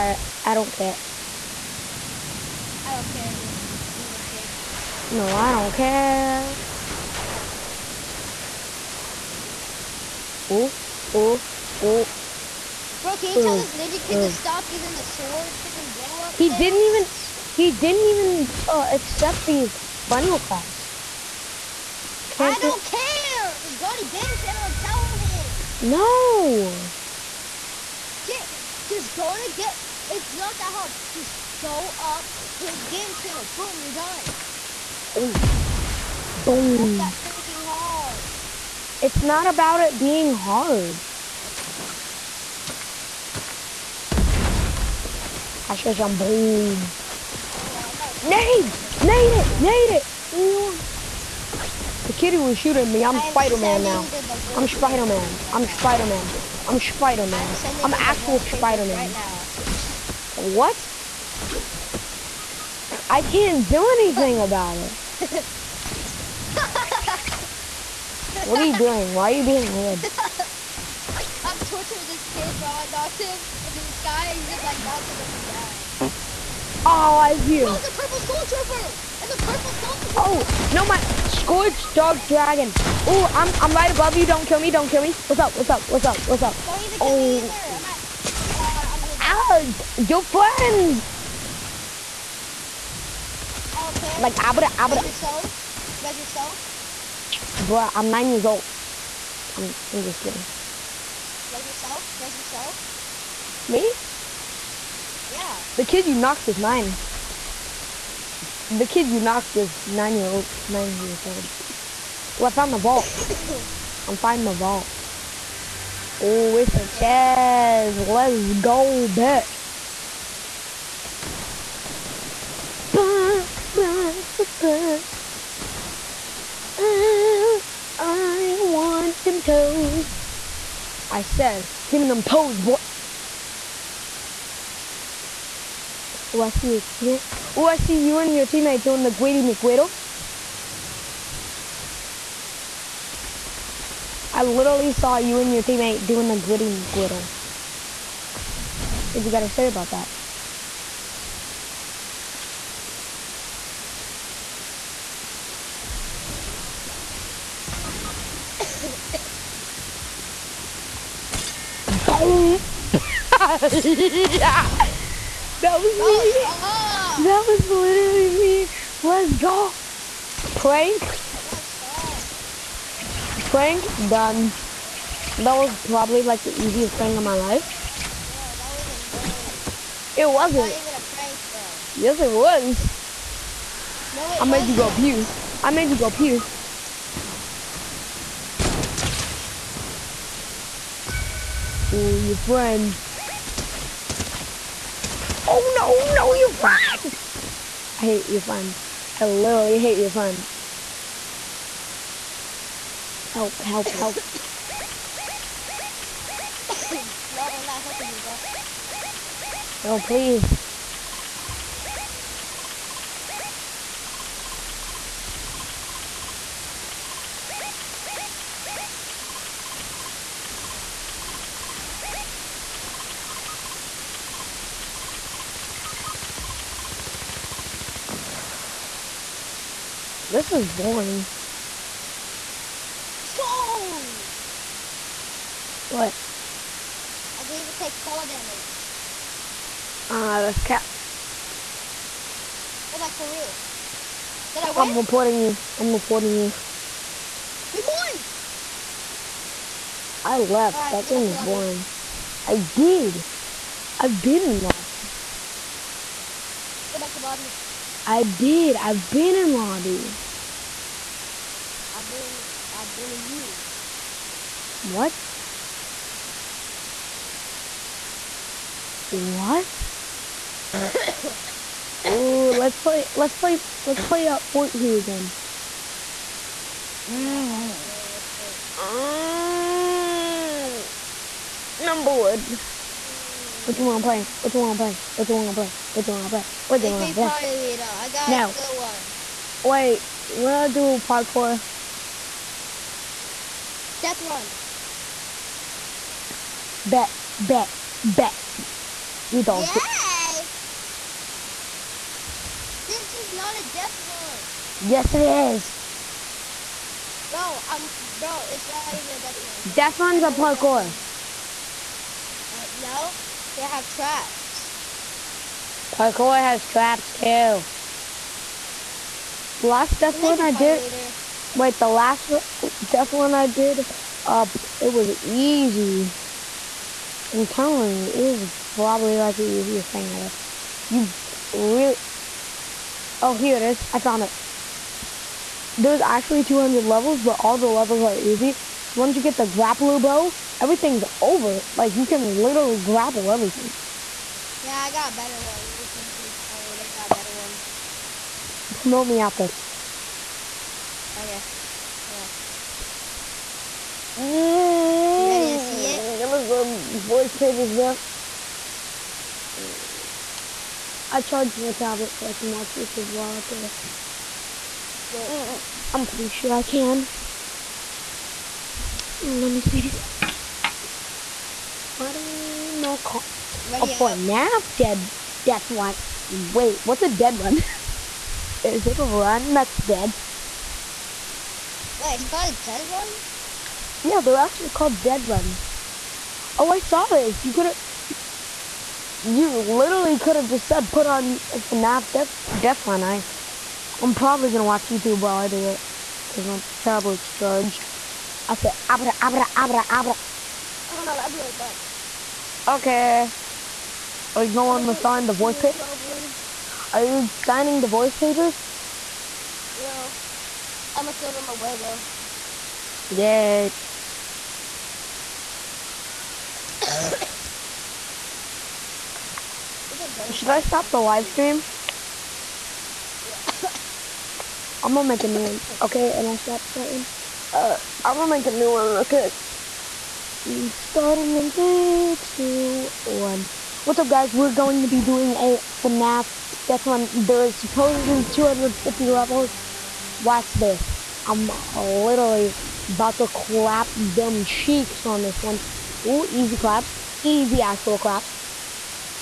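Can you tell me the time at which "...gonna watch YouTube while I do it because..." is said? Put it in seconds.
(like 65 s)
394 s.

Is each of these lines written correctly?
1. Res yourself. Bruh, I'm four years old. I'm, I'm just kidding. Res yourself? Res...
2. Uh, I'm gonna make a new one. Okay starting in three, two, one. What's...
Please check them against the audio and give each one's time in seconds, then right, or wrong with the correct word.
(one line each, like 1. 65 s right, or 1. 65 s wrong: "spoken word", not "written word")
1. 96 s wrong: "nine", not "four"
2. 427 s right.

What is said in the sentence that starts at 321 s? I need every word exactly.
Wait, the last death one I did.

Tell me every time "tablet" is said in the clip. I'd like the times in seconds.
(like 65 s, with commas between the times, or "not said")
361 s, 396 s.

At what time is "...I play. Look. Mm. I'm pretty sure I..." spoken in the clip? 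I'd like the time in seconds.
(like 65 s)
363 s.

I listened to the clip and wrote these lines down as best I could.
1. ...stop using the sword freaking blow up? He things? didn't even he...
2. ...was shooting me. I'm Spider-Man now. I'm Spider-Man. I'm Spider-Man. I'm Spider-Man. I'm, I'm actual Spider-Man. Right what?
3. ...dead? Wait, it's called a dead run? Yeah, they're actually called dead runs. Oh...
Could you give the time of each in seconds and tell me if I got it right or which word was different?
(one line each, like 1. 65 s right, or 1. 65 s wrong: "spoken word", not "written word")
1. 14 s right
2. 52 s right
3. 379 s right.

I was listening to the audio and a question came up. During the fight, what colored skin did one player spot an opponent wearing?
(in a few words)
Purple Skull Trooper.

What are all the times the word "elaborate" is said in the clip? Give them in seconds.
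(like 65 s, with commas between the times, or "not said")
not said.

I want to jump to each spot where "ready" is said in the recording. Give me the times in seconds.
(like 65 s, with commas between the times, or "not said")
355 s, 373 s.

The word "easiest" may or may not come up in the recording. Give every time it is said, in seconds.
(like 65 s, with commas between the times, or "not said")
176 s, 329 s.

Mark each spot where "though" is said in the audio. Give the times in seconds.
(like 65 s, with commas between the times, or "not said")
349 s, 411 s.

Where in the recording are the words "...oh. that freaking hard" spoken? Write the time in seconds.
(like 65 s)
36 s.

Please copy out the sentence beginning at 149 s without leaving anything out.
What you gotta say about that?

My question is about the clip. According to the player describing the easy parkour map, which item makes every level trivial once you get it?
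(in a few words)
Grapple bow.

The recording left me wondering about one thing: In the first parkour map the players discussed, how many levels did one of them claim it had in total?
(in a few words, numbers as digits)
200.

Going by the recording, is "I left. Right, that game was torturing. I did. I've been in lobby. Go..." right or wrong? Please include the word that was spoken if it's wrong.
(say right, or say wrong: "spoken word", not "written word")
wrong: "boring", not "torturing".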